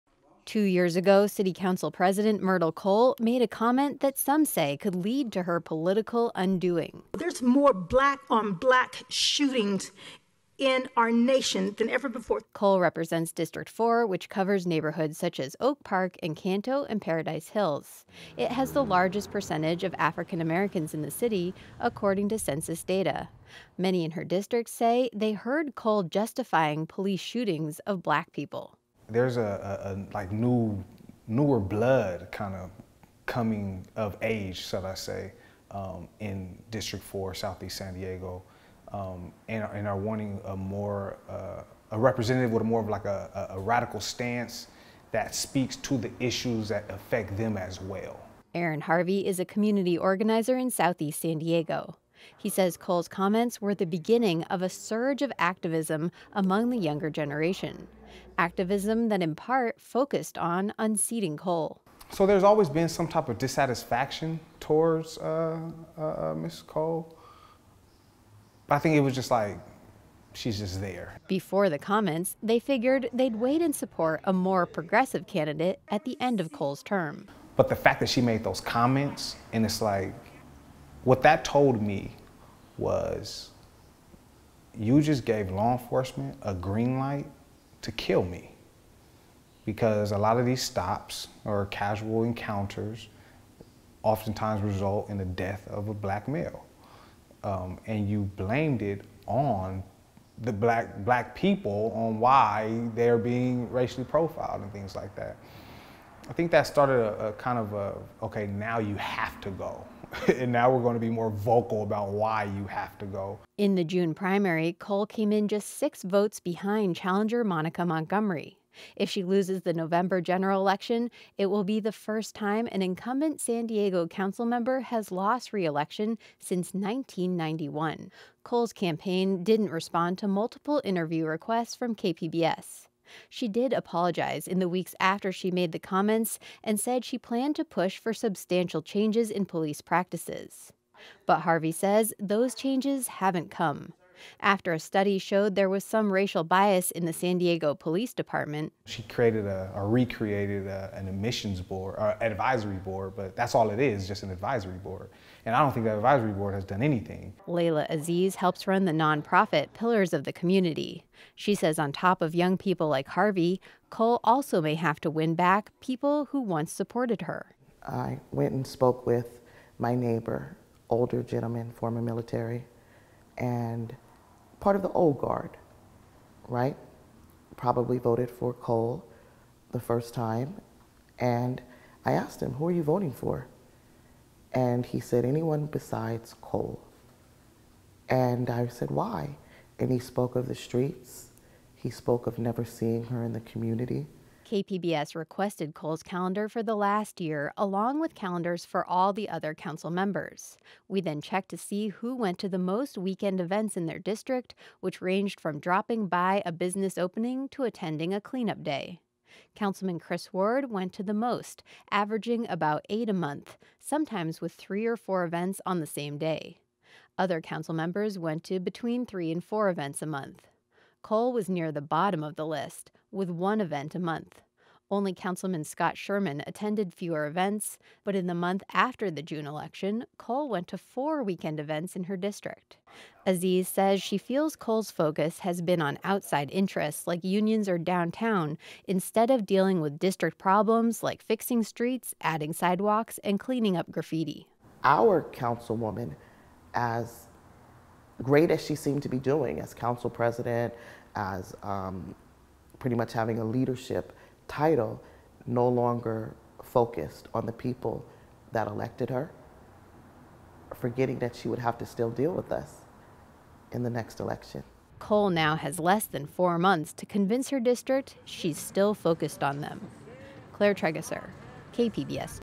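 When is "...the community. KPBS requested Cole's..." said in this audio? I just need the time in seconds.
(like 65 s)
193 s.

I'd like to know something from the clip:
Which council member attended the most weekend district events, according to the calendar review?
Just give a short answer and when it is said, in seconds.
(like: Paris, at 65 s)
Chris Ward, at 209 s.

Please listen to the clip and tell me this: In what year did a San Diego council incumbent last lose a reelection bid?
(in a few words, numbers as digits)
1991.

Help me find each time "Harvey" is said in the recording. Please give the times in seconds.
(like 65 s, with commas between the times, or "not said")
48 s, 141 s, 163 s.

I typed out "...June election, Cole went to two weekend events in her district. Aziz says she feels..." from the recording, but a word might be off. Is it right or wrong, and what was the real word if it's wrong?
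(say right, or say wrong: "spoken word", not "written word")
wrong: "four", not "two".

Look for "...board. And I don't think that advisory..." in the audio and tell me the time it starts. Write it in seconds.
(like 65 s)
154 s.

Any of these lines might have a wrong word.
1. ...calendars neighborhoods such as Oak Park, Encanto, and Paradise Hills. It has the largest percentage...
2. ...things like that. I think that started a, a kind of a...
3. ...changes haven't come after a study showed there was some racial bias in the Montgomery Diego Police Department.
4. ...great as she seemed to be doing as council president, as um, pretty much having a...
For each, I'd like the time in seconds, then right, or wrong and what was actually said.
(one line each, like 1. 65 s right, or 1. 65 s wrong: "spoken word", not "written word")
1. 14 s wrong: "covers", not "calendars"
2. 104 s right
3. 142 s wrong: "San", not "Montgomery"
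4. 248 s right.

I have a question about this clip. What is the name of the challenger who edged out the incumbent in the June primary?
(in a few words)
Monica Montgomery.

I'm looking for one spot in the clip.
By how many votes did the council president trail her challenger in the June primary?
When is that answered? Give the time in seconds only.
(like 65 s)
115 s.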